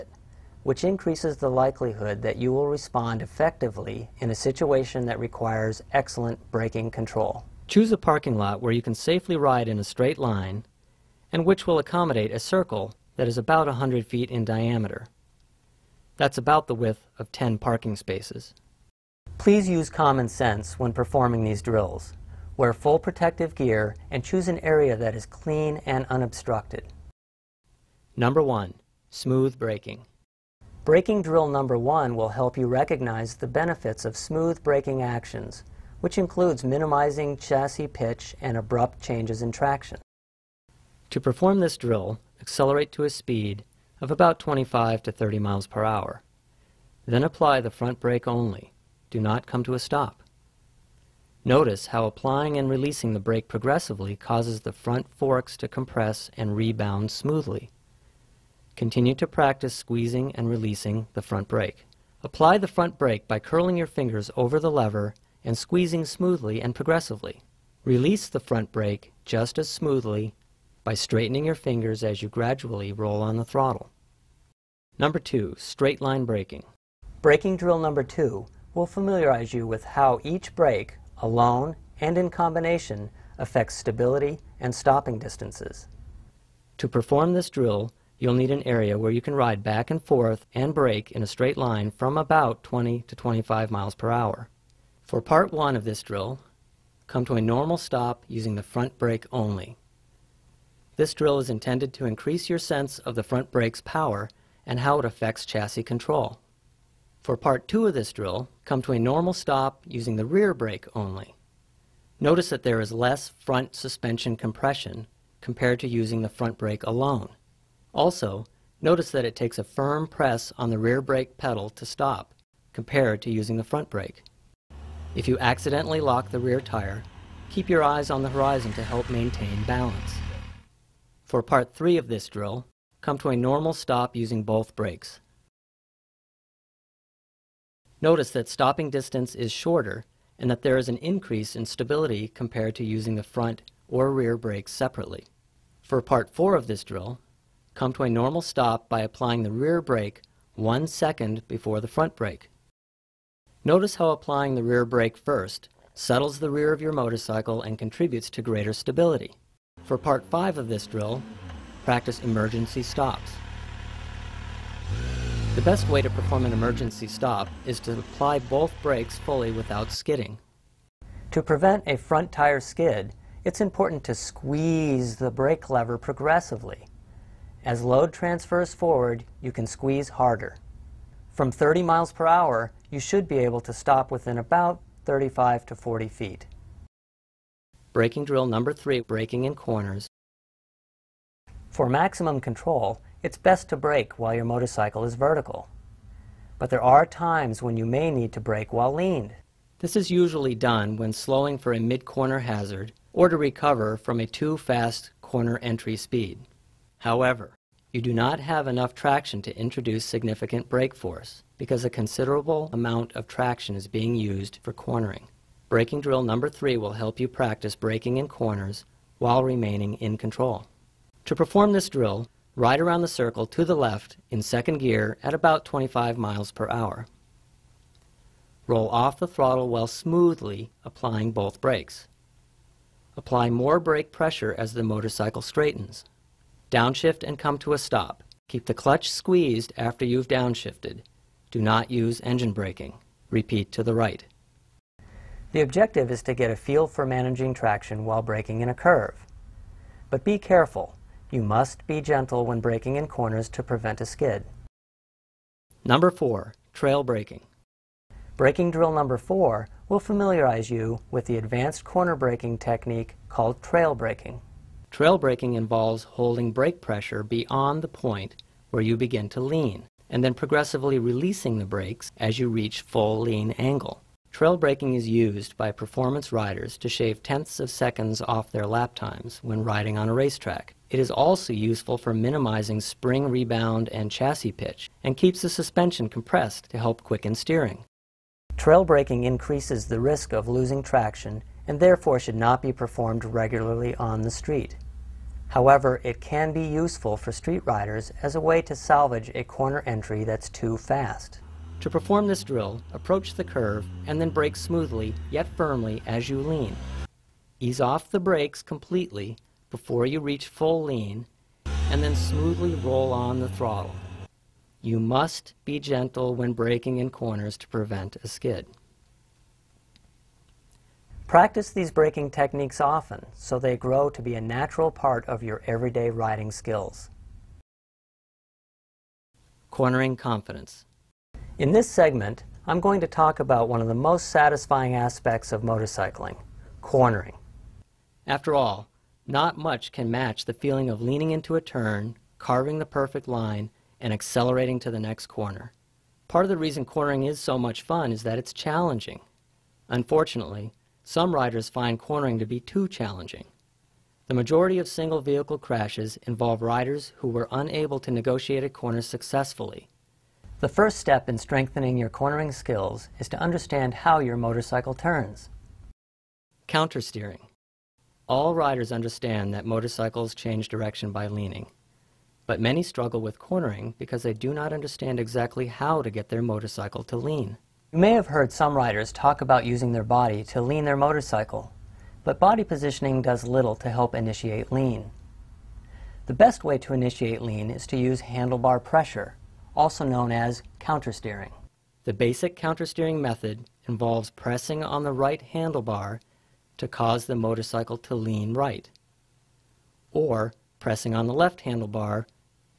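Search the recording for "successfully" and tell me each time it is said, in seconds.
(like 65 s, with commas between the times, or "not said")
359 s.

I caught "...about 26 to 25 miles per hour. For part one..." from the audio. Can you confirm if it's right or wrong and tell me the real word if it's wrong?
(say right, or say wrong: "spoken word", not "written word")
wrong: "20", not "26".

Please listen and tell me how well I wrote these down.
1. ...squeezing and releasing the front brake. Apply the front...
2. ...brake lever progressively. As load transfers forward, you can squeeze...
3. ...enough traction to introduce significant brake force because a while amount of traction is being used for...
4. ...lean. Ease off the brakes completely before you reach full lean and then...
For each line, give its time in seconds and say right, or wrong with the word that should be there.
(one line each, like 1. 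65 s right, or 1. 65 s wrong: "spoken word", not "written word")
1. 59 s right
2. 175 s right
3. 208 s wrong: "considerable", not "while"
4. 306 s right.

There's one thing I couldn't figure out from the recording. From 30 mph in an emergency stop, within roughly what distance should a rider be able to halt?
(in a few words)
35 to 40 feet.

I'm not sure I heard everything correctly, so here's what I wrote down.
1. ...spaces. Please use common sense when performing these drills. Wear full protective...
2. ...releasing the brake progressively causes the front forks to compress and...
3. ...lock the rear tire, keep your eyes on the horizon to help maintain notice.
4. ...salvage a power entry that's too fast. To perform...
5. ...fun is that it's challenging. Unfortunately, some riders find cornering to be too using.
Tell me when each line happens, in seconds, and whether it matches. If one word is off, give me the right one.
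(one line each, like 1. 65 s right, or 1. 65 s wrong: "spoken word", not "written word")
1. 17 s right
2. 52 s right
3. 125 s wrong: "balance", not "notice"
4. 298 s wrong: "corner", not "power"
5. 347 s wrong: "challenging", not "using".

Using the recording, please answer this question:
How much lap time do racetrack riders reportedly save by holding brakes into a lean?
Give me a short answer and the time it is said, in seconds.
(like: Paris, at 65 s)
tenths of seconds, at 277 s.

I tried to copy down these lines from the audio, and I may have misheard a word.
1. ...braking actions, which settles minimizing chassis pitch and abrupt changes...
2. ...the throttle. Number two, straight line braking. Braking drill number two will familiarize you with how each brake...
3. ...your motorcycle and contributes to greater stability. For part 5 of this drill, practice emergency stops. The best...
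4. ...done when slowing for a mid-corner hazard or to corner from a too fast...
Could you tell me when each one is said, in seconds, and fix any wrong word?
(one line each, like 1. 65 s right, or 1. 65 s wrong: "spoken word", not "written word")
1. 34 s wrong: "includes", not "settles"
2. 73 s right
3. 156 s right
4. 200 s wrong: "recover", not "corner".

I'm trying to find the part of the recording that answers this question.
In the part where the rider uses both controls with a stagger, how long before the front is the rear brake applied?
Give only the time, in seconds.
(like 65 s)
150 s.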